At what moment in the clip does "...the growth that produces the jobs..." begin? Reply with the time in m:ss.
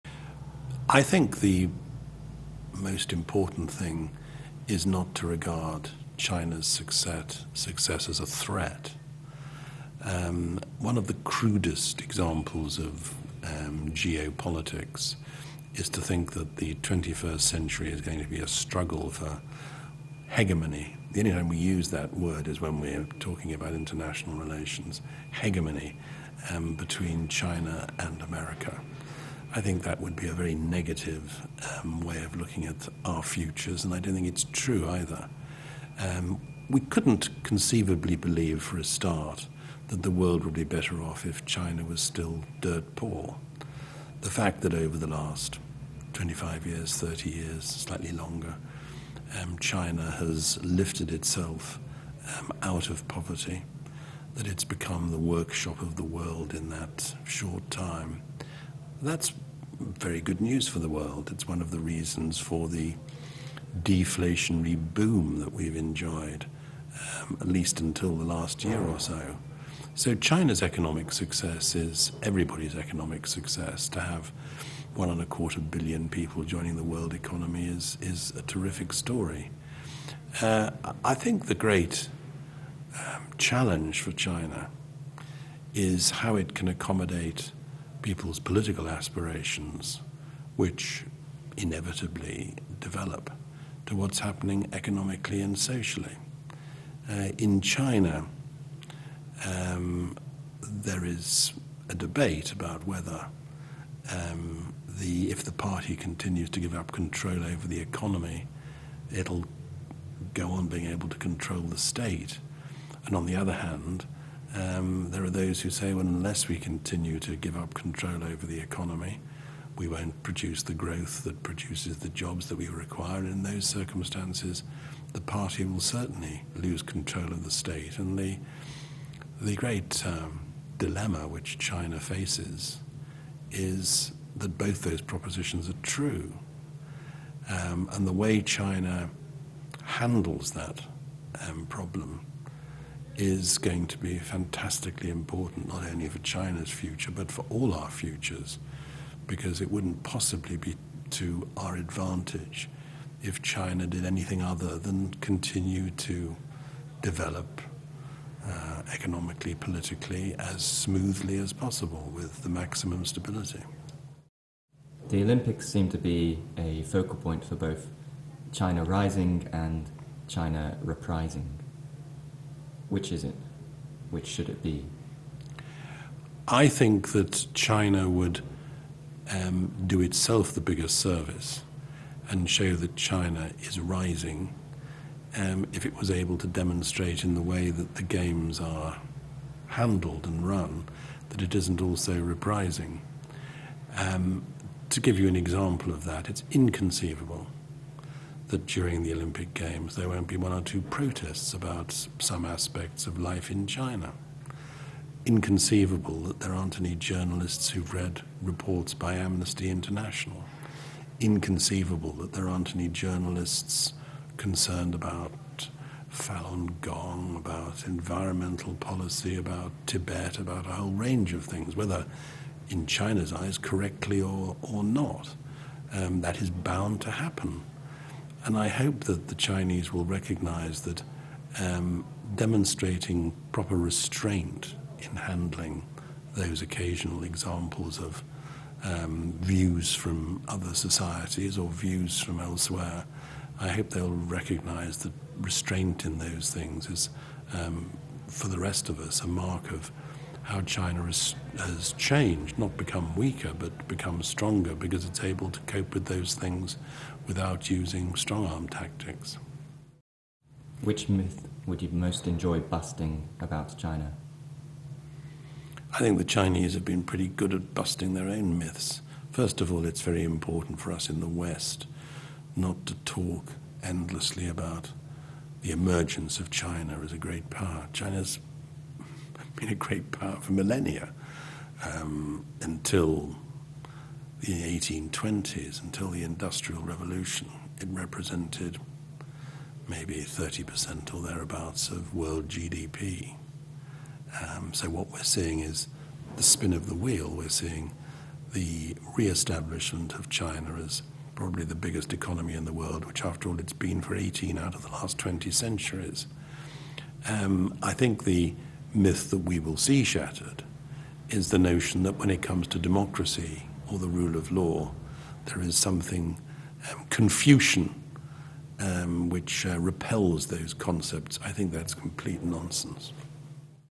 2:00.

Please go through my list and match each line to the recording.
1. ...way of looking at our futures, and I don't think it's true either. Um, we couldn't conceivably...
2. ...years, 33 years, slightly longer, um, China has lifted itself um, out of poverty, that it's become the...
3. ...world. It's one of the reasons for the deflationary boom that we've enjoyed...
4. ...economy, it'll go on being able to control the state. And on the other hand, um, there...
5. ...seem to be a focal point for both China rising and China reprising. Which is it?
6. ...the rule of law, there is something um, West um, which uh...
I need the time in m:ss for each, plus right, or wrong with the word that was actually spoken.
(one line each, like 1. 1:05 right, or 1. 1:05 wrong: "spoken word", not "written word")
1. 0:31 right
2. 0:46 wrong: "30", not "33"
3. 1:00 right
4. 1:47 right
5. 2:45 right
6. 5:13 wrong: "Confucian", not "West".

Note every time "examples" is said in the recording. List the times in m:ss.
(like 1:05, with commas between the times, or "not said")
0:12, 3:15, 3:57.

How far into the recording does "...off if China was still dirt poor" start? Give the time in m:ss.
0:41.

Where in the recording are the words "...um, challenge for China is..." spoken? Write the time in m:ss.
1:22.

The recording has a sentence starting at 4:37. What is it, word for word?
China's been a great power for millennia um, until the 1820s, until the Industrial Revolution.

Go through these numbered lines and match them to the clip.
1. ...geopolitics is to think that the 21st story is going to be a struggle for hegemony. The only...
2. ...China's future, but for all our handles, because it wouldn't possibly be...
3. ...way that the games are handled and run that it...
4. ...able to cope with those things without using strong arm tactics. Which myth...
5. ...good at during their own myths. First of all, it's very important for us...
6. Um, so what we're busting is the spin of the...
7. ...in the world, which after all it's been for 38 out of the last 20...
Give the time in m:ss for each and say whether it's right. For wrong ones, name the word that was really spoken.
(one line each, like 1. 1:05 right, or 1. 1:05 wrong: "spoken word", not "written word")
1. 0:13 wrong: "century", not "story"
2. 2:26 wrong: "futures", not "handles"
3. 3:07 right
4. 4:15 right
5. 4:27 wrong: "busting", not "during"
6. 4:54 wrong: "seeing", not "busting"
7. 5:02 wrong: "18", not "38".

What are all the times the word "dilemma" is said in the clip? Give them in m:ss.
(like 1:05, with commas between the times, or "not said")
2:10.